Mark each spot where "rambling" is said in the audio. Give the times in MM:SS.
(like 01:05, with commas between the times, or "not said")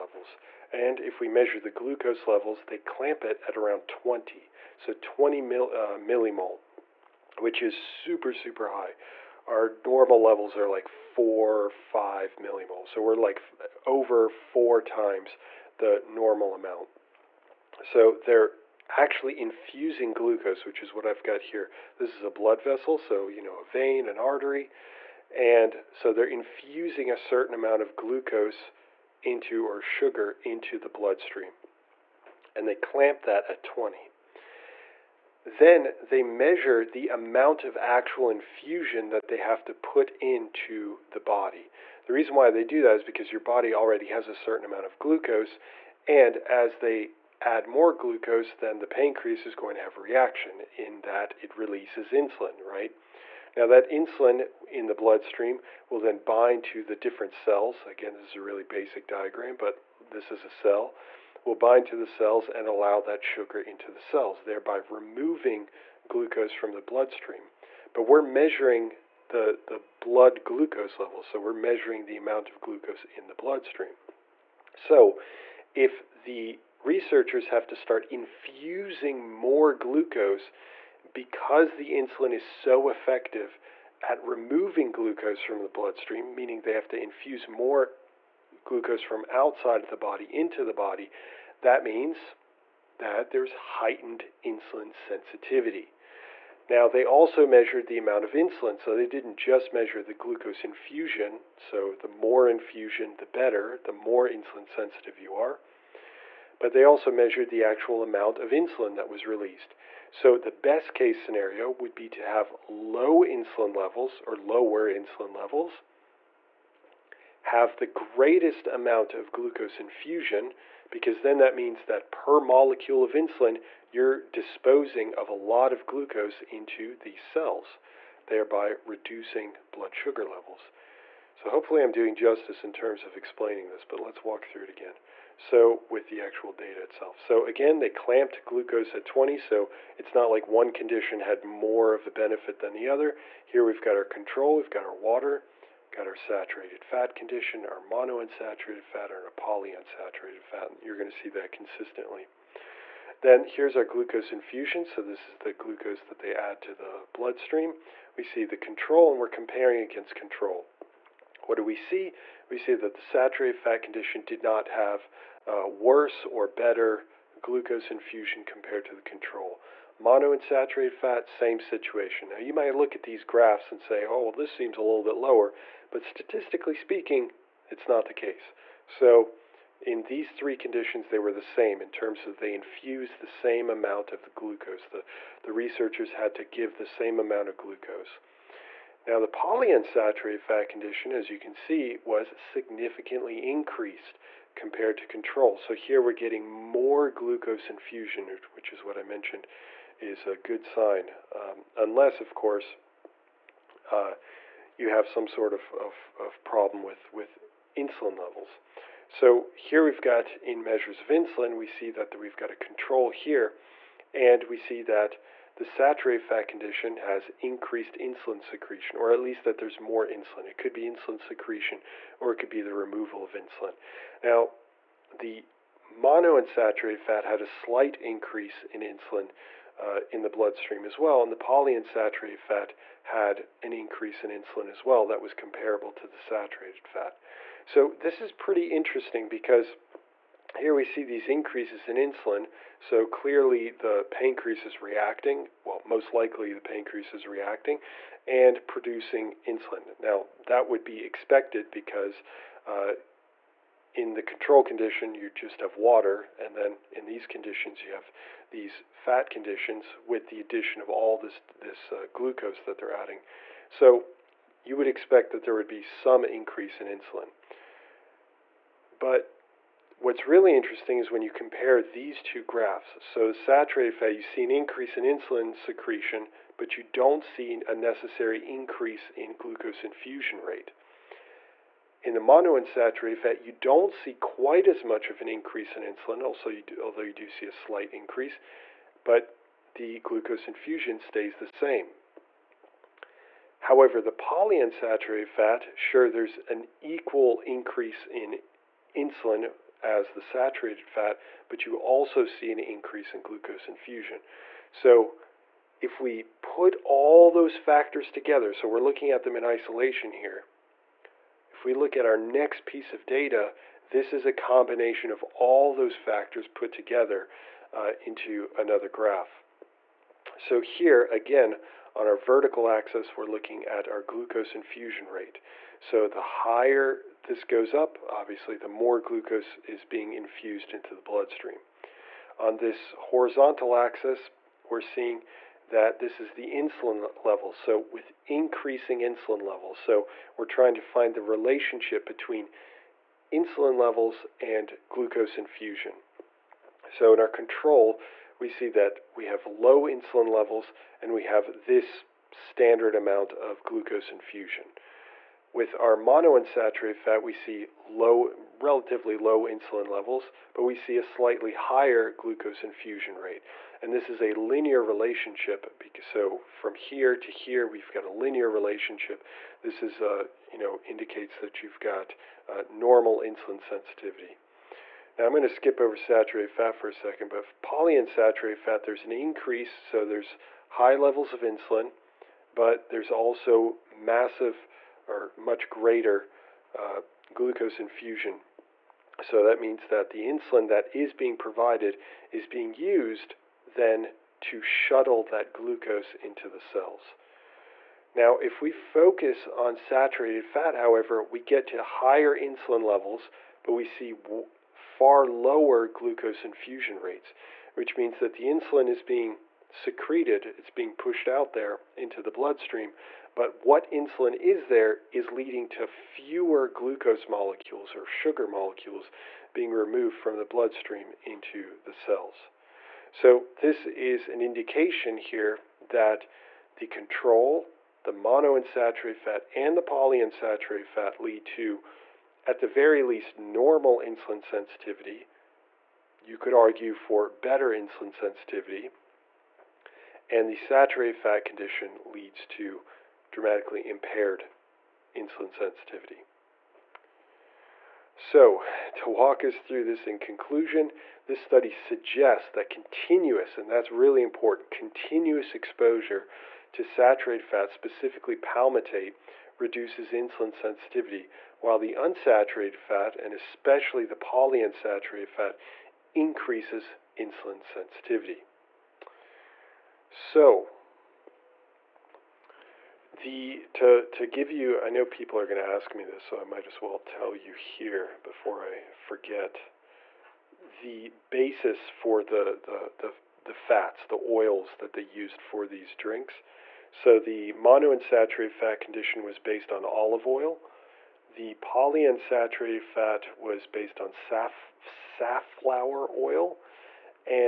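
not said.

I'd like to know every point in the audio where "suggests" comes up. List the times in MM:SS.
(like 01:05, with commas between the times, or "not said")
07:31.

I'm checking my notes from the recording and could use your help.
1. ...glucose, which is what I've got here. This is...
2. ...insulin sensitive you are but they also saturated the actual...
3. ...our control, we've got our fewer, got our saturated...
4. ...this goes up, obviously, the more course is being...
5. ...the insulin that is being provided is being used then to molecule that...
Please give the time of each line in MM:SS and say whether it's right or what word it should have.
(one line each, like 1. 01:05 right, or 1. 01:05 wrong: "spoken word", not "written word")
1. 00:20 right
2. 01:44 wrong: "measured", not "saturated"
3. 02:23 wrong: "water", not "fewer"
4. 05:27 wrong: "glucose", not "course"
5. 06:30 wrong: "shuttle", not "molecule".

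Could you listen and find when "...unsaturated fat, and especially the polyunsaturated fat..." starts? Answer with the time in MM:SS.
07:41.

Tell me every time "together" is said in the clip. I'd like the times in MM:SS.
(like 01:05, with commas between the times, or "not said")
05:08, 05:16.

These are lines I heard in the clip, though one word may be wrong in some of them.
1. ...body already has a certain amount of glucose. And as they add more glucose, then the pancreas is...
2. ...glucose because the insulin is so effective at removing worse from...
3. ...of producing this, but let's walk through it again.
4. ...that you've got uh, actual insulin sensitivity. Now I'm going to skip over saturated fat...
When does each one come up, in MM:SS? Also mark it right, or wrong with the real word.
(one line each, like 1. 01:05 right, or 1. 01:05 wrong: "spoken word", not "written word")
1. 00:43 right
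2. 01:19 wrong: "glucose", not "worse"
3. 02:13 wrong: "explaining", not "producing"
4. 06:11 wrong: "normal", not "actual".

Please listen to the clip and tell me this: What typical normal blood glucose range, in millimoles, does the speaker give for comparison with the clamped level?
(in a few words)
4 or 5.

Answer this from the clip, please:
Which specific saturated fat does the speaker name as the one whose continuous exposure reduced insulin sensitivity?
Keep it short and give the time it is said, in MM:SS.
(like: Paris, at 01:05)
palmitate, at 07:38.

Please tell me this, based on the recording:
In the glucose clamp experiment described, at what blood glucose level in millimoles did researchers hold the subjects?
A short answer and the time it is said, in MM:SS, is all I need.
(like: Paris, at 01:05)
20, at 00:04.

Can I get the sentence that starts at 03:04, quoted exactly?
The, the researchers had to give the same amount of glucose.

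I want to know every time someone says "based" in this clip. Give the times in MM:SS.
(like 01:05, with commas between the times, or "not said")
08:09, 08:13.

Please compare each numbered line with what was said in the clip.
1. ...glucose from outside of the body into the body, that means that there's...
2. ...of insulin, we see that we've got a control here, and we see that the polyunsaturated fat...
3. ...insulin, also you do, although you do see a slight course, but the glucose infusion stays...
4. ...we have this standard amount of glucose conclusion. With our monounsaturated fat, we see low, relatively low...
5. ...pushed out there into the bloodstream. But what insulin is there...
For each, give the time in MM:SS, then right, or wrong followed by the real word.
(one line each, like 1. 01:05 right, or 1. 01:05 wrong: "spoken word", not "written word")
1. 01:28 right
2. 03:30 wrong: "saturated", not "polyunsaturated"
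3. 04:45 wrong: "increase", not "course"
4. 05:51 wrong: "infusion", not "conclusion"
5. 06:50 right.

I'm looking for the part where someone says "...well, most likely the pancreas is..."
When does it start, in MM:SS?
04:05.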